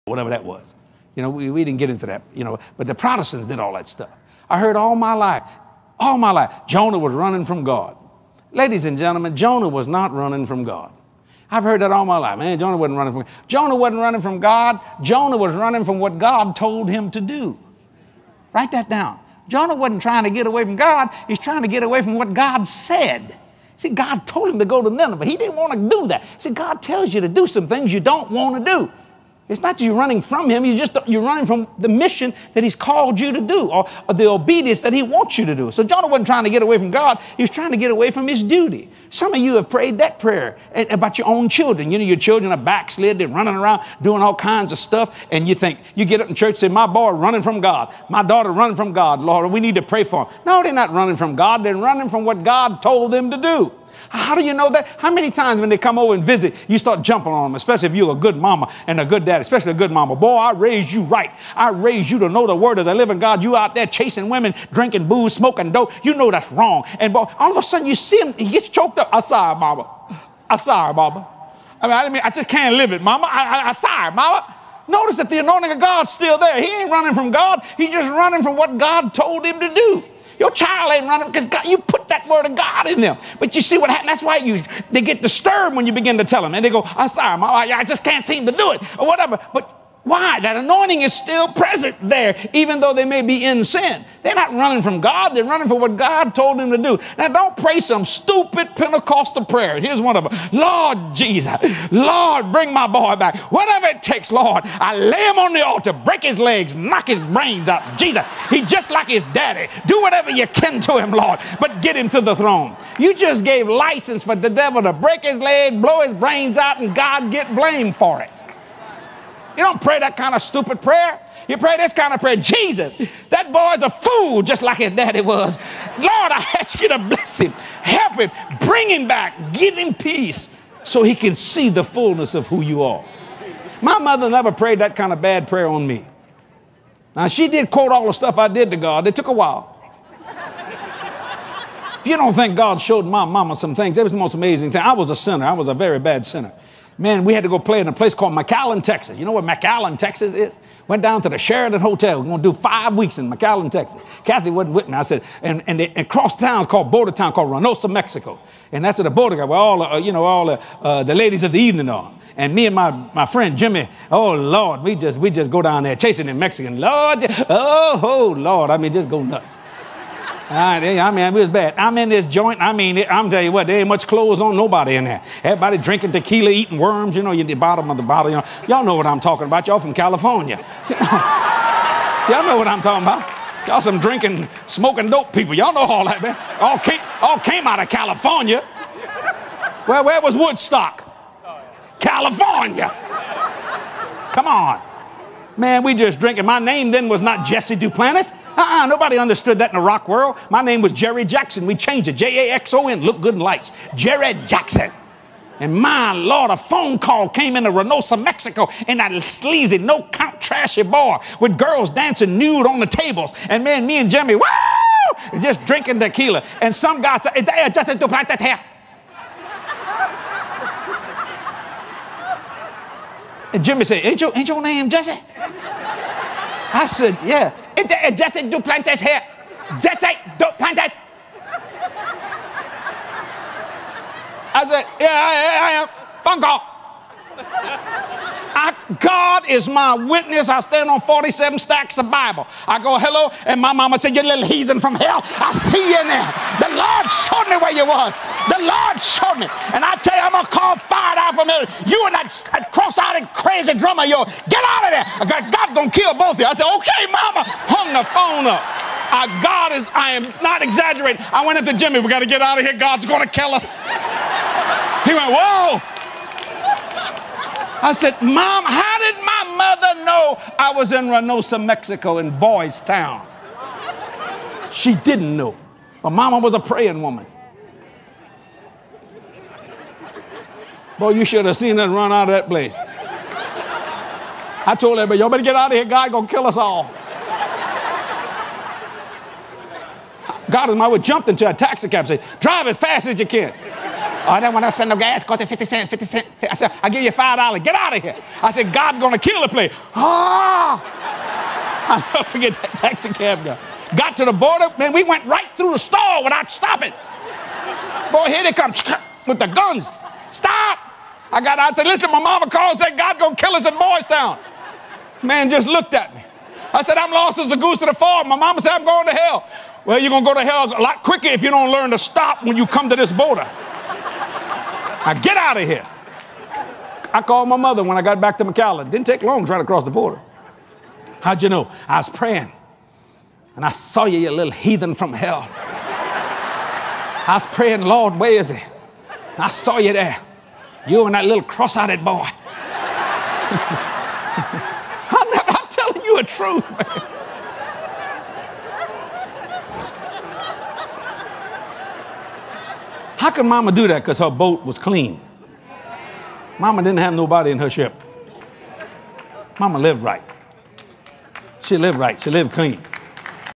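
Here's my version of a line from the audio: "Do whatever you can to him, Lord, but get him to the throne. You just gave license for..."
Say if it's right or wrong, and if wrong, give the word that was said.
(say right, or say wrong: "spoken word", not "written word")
right.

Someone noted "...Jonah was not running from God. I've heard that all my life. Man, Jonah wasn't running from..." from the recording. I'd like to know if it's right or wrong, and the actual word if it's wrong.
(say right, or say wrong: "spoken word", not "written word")
right.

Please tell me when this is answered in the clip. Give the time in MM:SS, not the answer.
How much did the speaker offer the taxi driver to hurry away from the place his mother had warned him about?
04:57.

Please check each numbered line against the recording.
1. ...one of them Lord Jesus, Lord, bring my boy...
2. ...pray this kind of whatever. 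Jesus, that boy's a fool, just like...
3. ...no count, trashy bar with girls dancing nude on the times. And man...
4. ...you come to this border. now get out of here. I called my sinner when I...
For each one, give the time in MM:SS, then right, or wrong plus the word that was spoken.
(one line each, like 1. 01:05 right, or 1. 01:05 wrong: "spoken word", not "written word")
1. 01:40 right
2. 02:01 wrong: "prayer", not "whatever"
3. 03:29 wrong: "tables", not "times"
4. 05:22 wrong: "mother", not "sinner".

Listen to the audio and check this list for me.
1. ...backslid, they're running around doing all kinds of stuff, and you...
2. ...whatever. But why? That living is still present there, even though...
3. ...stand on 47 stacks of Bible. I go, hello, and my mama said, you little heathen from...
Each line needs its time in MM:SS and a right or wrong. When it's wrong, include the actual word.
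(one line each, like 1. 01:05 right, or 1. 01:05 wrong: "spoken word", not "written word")
1. 00:42 right
2. 01:29 wrong: "anointing", not "living"
3. 04:00 right.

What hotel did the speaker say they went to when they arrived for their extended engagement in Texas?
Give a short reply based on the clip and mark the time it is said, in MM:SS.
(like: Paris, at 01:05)
Sheraton Hotel, at 02:31.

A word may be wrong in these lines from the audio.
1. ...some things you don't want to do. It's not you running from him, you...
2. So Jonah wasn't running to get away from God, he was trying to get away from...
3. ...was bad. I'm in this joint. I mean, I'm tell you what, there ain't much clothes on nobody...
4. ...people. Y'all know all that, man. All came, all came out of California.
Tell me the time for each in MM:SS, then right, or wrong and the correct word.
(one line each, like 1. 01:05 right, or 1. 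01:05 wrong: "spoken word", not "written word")
1. 00:27 right
2. 00:35 wrong: "trying", not "running"
3. 02:51 right
4. 03:05 right.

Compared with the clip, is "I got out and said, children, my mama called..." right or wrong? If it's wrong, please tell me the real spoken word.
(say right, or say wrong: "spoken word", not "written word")
wrong: "listen", not "children".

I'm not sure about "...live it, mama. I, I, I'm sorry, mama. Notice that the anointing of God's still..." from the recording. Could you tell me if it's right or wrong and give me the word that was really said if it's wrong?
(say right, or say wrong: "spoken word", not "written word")
right.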